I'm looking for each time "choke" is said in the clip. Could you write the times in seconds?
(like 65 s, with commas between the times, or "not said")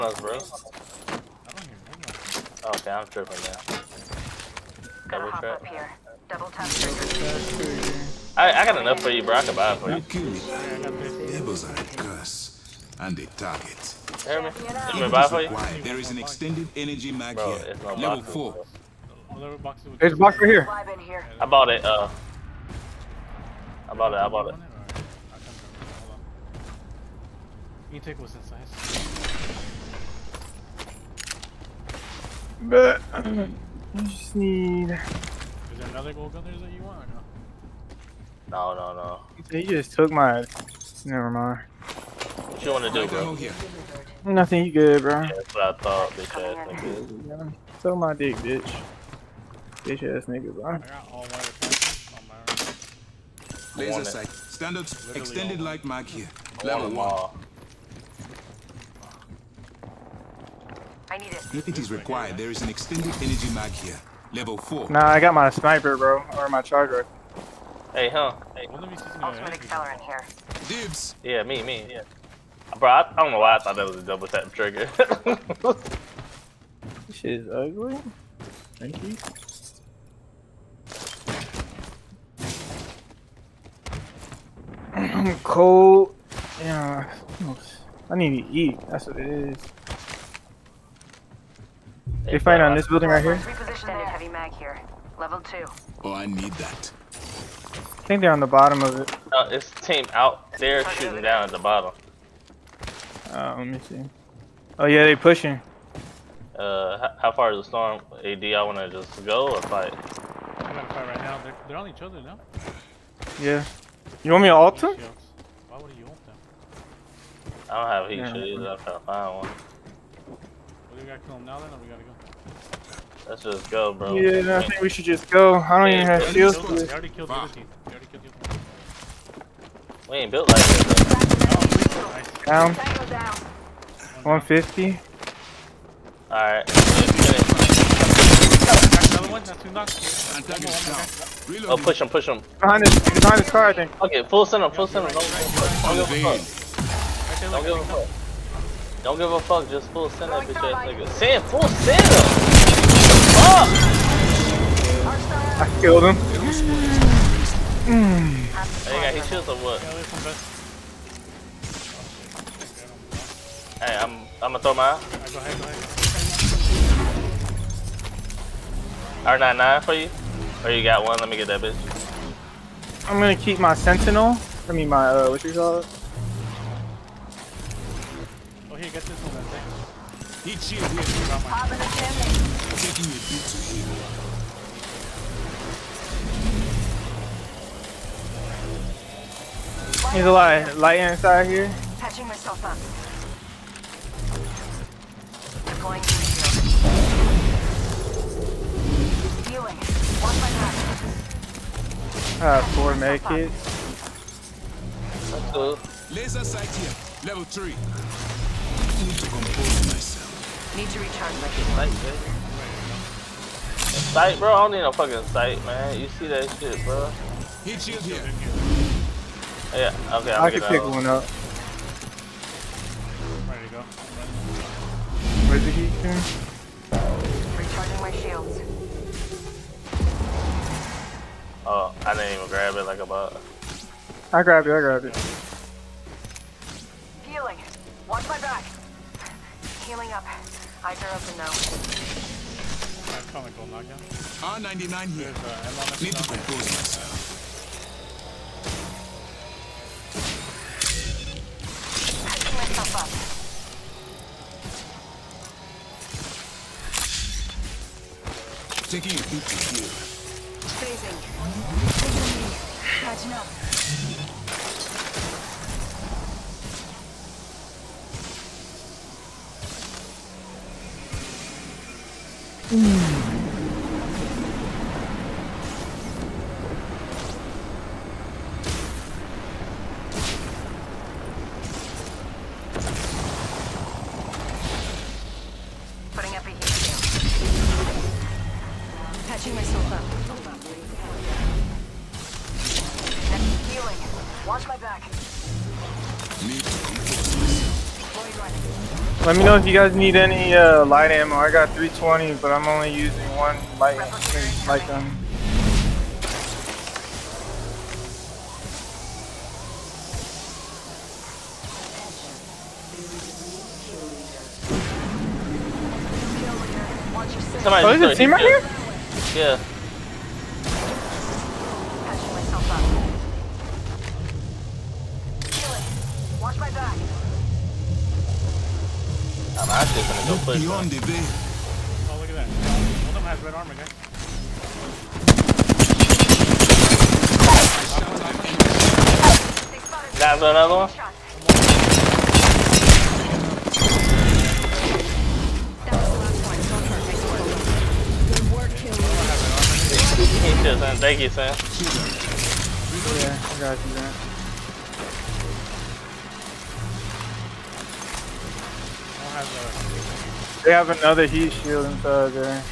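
not said.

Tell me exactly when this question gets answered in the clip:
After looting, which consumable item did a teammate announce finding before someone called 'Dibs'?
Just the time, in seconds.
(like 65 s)
68 s.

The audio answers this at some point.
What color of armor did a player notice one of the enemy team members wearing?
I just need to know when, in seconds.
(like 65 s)
333 s.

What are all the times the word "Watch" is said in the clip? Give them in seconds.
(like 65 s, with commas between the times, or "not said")
238 s.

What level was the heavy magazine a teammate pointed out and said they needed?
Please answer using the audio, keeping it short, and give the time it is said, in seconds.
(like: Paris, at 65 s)
Level 2, at 95 s.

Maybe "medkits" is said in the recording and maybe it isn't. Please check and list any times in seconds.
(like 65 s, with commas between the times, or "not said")
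202 s.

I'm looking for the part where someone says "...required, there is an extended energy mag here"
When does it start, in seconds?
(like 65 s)
61 s.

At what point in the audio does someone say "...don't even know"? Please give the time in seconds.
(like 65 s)
0 s.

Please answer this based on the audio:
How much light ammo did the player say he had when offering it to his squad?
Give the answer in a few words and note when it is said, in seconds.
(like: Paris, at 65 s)
320, at 301 s.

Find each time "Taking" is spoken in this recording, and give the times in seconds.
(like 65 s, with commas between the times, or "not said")
182 s, 258 s.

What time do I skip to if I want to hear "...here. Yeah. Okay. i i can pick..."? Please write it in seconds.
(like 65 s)
217 s.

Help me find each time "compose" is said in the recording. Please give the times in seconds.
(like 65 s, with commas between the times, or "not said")
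246 s.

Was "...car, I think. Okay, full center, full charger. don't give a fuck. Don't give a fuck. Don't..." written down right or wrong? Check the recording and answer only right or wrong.
wrong.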